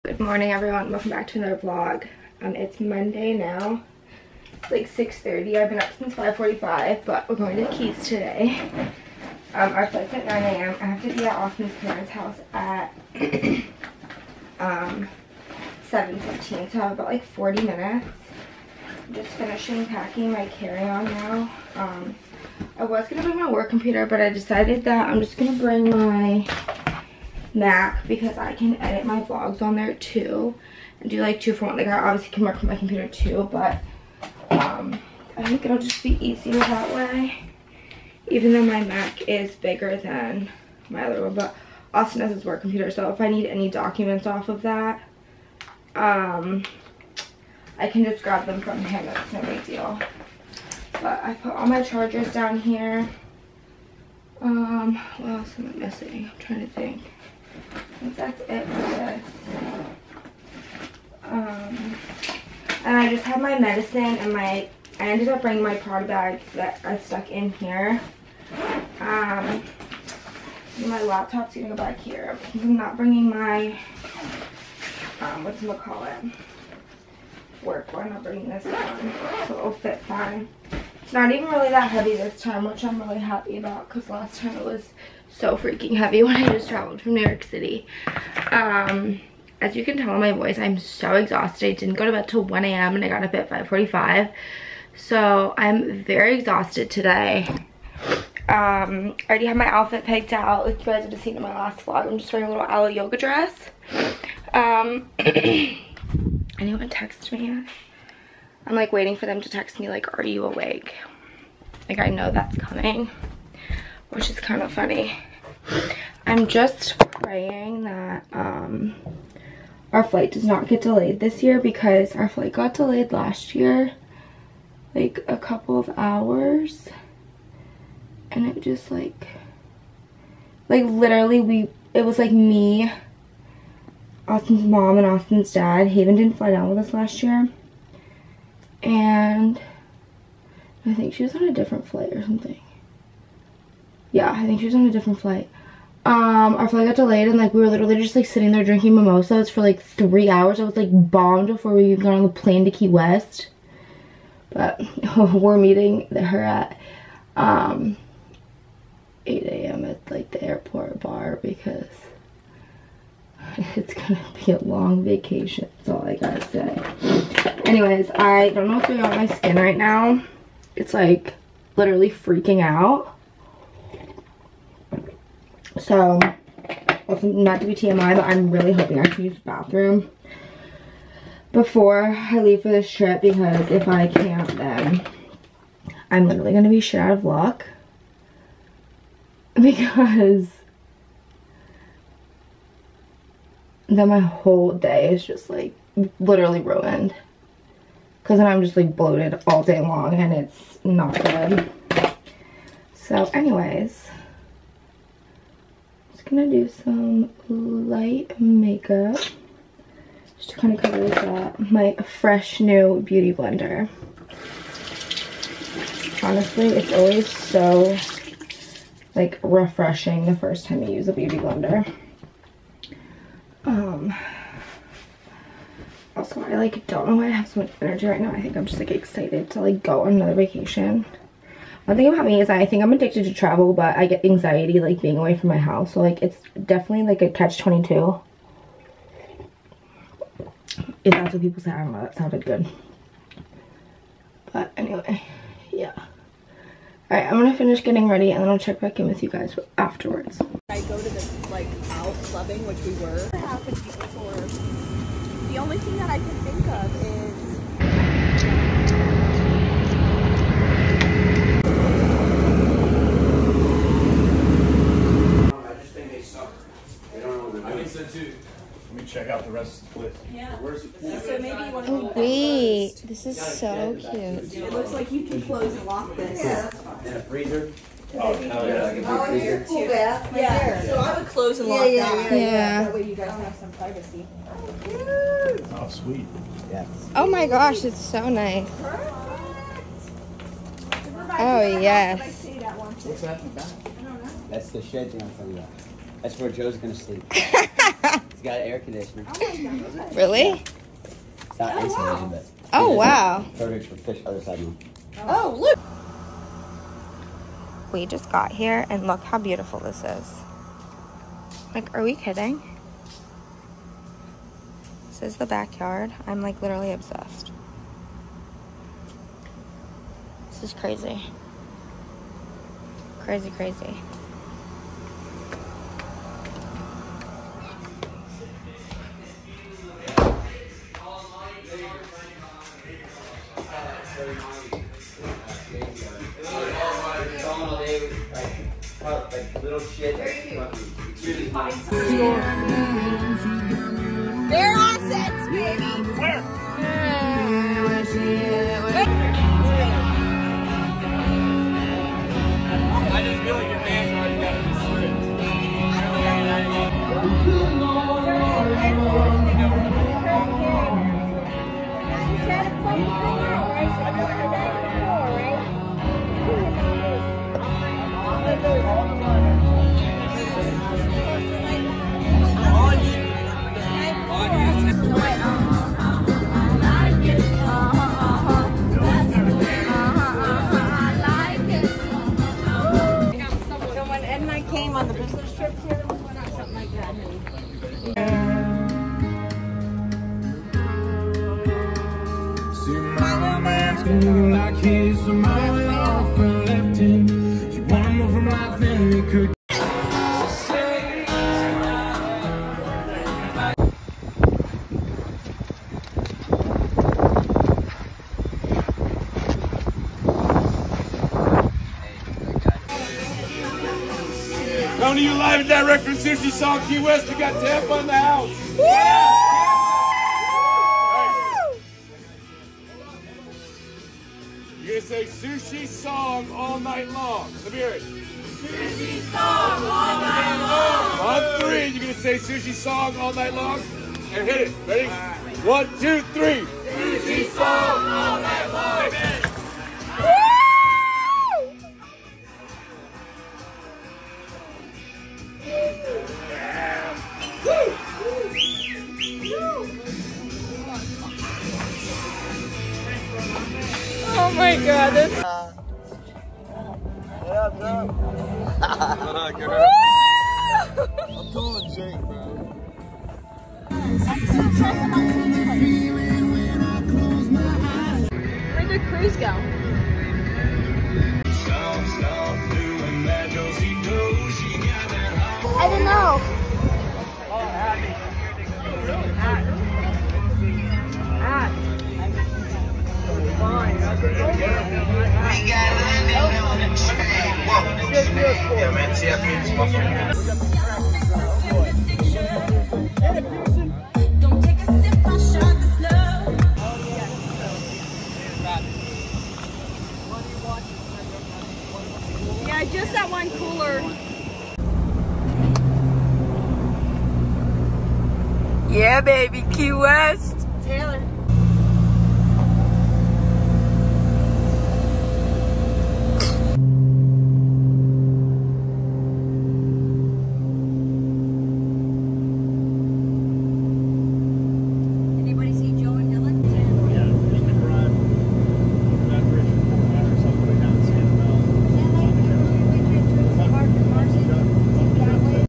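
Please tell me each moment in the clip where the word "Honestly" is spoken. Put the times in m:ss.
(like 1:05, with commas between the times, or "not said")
3:36.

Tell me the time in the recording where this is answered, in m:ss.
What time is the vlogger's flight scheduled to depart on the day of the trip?
0:10.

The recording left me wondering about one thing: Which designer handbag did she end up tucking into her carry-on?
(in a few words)
Prada.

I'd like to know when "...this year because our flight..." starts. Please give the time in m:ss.
2:01.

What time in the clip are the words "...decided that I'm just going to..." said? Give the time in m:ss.
0:24.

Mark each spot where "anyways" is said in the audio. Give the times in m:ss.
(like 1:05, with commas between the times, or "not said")
2:47, 3:23, 4:04.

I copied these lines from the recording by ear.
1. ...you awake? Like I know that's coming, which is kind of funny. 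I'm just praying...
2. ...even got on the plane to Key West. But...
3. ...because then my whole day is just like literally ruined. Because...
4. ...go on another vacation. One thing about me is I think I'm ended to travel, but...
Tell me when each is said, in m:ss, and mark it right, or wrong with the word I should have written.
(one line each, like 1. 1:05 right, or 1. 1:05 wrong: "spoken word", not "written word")
1. 1:50 right
2. 2:31 right
3. 3:09 right
4. 3:49 wrong: "addicted", not "ended".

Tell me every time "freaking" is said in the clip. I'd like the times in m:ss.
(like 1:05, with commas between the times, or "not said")
1:25, 2:52.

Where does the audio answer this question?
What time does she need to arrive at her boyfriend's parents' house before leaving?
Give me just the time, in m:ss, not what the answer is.
0:15.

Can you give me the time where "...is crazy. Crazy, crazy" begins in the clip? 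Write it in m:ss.
5:20.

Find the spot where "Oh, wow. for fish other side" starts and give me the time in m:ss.
5:02.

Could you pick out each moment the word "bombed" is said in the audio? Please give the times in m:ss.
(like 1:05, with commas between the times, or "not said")
2:30.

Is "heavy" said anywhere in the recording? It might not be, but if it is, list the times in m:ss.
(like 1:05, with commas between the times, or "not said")
1:21, 1:25.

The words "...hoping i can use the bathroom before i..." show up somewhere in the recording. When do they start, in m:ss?
2:58.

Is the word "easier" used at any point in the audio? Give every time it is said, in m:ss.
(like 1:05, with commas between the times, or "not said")
0:36.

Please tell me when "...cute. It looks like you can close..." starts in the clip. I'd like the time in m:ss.
4:33.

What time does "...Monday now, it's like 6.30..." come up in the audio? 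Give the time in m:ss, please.
0:02.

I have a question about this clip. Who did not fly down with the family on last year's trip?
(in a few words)
Haven.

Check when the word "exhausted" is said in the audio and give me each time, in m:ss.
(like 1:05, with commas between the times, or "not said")
1:31, 1:36.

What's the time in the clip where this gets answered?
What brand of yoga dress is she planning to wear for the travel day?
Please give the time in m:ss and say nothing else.
1:42.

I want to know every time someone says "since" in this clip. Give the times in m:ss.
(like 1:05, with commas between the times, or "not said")
0:05.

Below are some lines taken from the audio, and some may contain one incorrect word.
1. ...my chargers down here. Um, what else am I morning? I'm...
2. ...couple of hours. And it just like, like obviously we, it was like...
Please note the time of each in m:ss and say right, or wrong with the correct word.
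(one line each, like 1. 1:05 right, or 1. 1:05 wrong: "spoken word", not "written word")
1. 0:51 wrong: "missing", not "morning"
2. 2:05 wrong: "literally", not "obviously".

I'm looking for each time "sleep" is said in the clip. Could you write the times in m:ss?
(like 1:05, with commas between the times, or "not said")
4:56.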